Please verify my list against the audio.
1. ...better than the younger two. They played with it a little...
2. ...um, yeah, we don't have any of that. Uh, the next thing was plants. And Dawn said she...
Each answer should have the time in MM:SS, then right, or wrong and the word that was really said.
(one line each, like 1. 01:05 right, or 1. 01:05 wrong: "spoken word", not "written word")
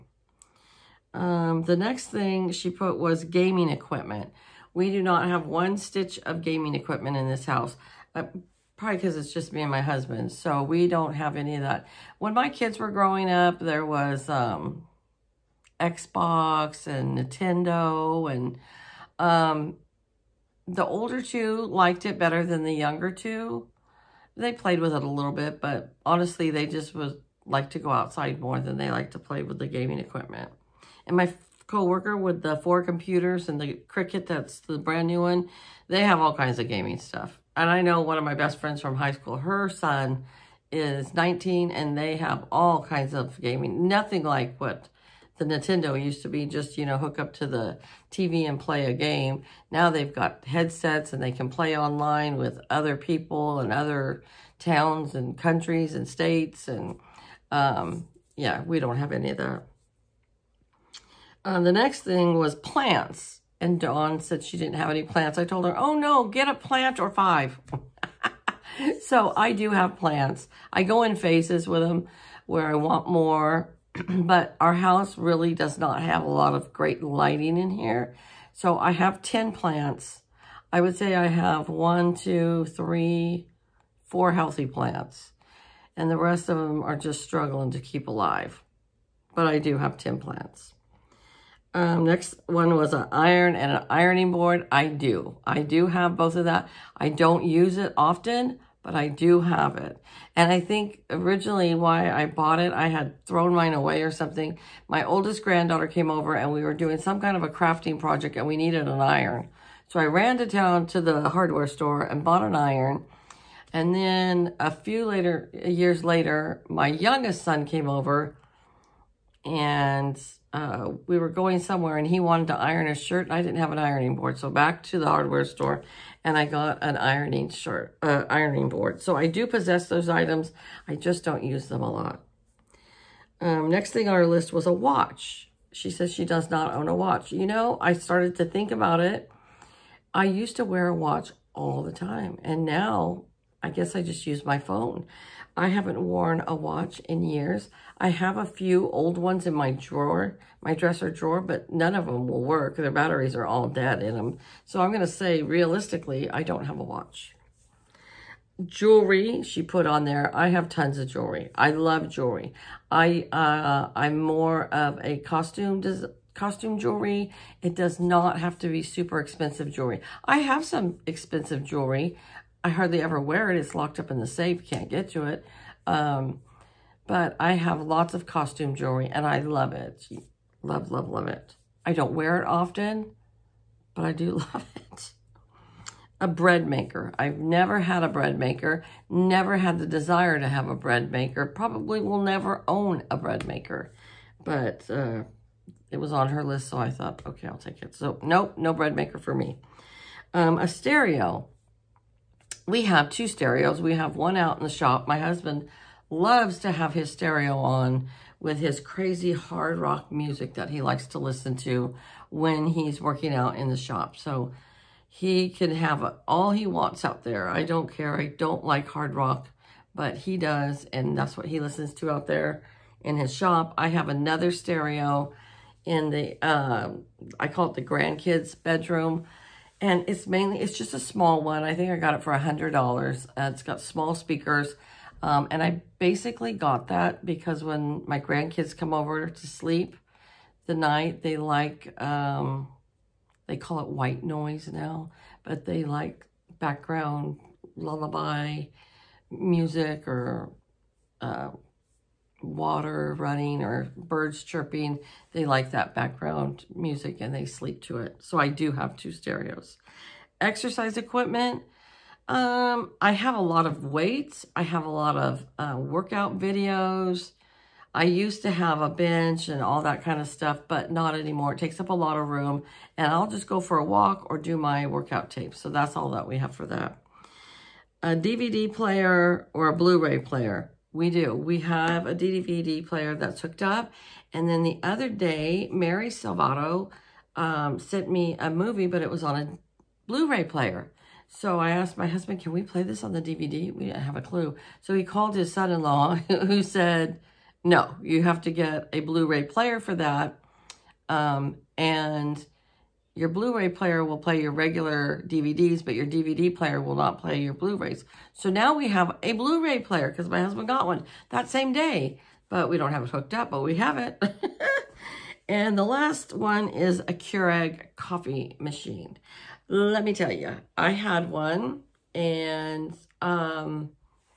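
1. 00:22 right
2. 00:57 right.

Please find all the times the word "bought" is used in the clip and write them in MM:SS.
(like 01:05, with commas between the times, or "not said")
01:42, 01:52.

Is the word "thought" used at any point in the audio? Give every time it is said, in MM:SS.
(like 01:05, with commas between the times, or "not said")
03:16.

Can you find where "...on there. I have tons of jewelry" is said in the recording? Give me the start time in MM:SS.
02:39.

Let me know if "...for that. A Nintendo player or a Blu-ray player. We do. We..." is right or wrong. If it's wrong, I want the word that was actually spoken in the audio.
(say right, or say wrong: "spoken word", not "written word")
wrong: "DVD", not "Nintendo".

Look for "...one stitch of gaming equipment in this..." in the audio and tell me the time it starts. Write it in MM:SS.
00:05.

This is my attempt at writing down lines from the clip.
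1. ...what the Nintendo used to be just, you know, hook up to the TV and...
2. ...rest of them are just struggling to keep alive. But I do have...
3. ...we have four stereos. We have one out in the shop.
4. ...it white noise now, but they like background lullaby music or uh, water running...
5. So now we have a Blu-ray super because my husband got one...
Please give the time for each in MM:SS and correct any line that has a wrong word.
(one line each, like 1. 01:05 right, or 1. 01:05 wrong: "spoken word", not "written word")
1. 00:44 right
2. 01:26 right
3. 03:22 wrong: "two", not "four"
4. 04:03 right
5. 05:08 wrong: "player", not "super".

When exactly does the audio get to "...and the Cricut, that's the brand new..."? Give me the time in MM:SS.
00:33.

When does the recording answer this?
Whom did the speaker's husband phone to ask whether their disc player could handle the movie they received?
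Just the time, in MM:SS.
04:55.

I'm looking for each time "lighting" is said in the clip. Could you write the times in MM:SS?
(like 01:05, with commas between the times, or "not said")
01:17.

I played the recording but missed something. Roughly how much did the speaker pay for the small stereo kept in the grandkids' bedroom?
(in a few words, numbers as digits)
$100.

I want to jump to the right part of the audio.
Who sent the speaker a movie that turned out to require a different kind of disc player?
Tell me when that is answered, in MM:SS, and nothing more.
04:45.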